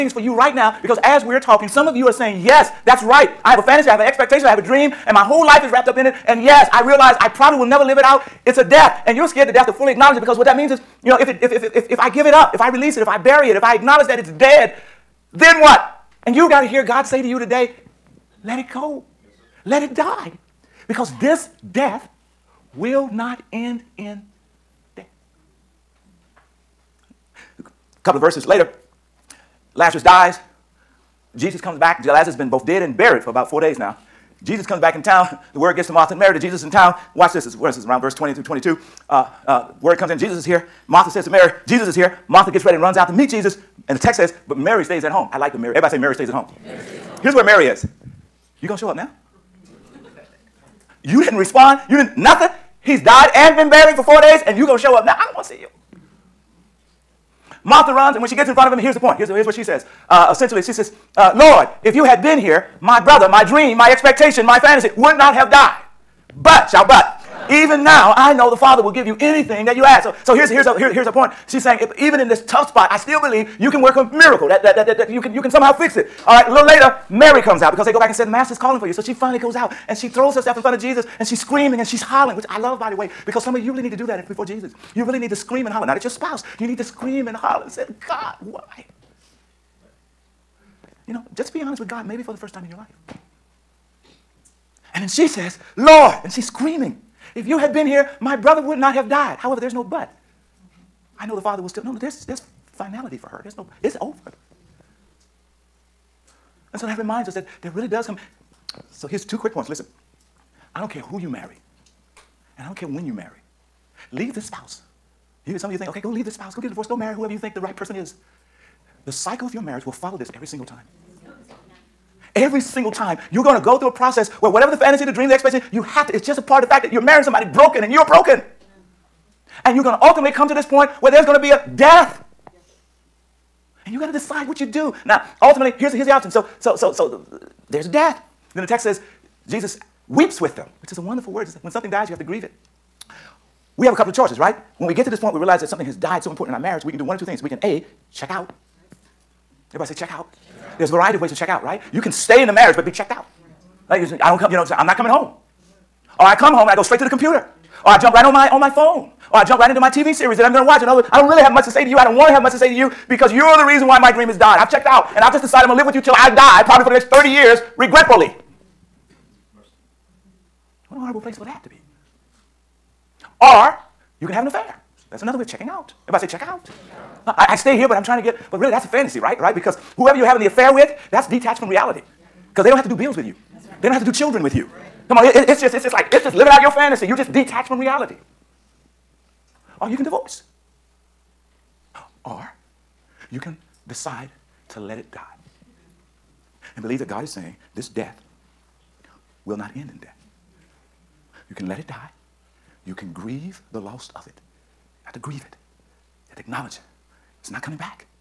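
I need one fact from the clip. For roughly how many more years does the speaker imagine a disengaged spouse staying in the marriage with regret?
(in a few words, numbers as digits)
30.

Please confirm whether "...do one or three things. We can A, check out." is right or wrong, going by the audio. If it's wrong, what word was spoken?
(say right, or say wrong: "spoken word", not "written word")
wrong: "two", not "three".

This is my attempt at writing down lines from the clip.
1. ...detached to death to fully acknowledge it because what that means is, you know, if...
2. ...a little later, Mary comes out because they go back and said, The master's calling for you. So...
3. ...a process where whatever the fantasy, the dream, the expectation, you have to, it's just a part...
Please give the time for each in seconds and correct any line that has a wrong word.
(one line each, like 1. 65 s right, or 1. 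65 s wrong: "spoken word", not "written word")
1. 9 s wrong: "scared", not "detached"
2. 76 s right
3. 123 s right.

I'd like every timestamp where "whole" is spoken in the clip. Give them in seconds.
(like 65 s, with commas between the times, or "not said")
5 s.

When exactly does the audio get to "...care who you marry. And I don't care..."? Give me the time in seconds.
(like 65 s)
110 s.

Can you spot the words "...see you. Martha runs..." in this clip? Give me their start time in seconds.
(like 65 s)
55 s.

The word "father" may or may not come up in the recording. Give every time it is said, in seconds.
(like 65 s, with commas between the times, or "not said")
68 s, 101 s.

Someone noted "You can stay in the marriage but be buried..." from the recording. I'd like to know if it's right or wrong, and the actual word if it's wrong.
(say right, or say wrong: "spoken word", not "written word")
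wrong: "checked", not "buried".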